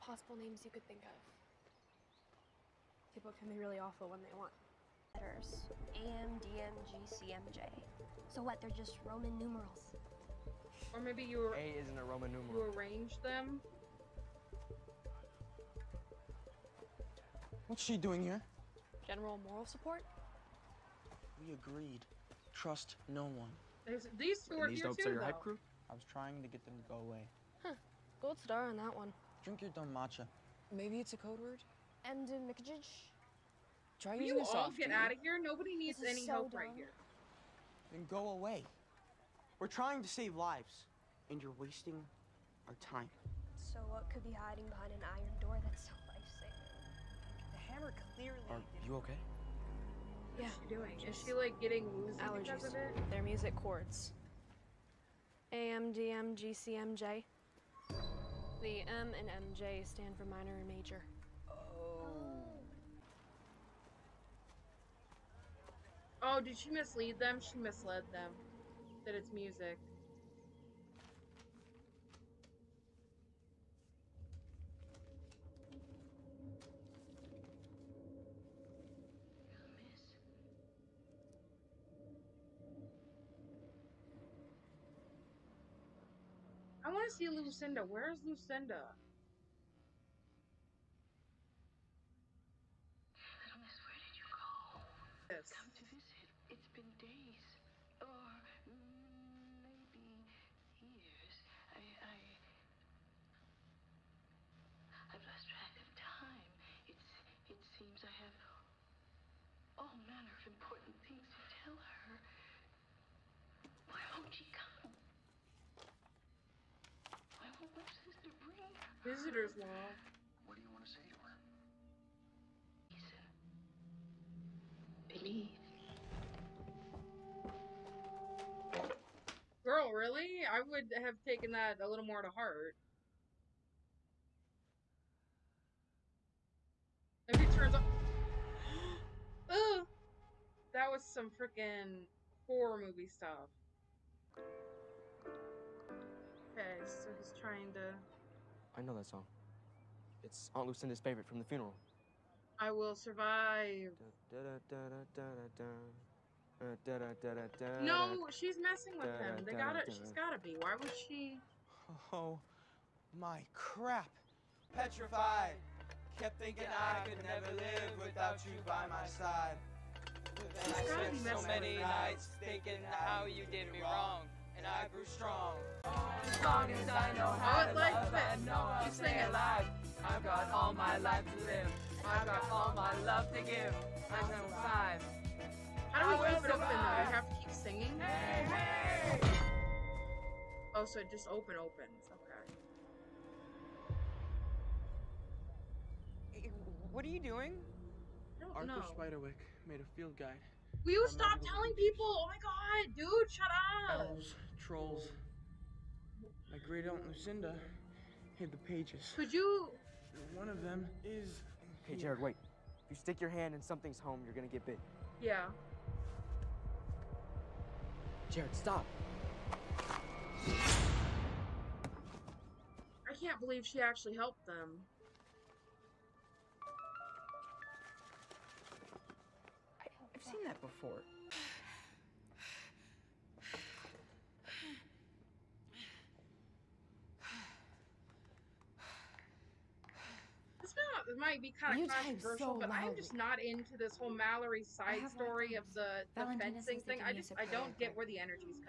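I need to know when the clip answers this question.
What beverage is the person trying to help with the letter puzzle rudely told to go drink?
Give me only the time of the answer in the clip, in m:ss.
0:29.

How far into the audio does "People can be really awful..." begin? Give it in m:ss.
0:03.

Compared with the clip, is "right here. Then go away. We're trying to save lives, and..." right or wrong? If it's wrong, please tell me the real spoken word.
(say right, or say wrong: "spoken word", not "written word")
right.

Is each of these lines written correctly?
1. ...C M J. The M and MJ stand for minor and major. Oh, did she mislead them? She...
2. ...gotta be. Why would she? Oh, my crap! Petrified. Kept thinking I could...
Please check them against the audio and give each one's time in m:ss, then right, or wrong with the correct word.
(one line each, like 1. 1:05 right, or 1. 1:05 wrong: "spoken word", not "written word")
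1. 0:56 right
2. 2:40 right.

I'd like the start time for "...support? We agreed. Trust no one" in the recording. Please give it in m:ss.
0:19.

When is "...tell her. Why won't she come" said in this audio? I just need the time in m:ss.
1:51.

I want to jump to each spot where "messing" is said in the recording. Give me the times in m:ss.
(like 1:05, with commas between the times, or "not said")
2:38.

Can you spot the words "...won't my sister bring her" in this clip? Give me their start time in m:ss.
1:57.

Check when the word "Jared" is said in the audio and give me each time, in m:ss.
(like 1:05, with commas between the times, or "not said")
3:31, 3:38.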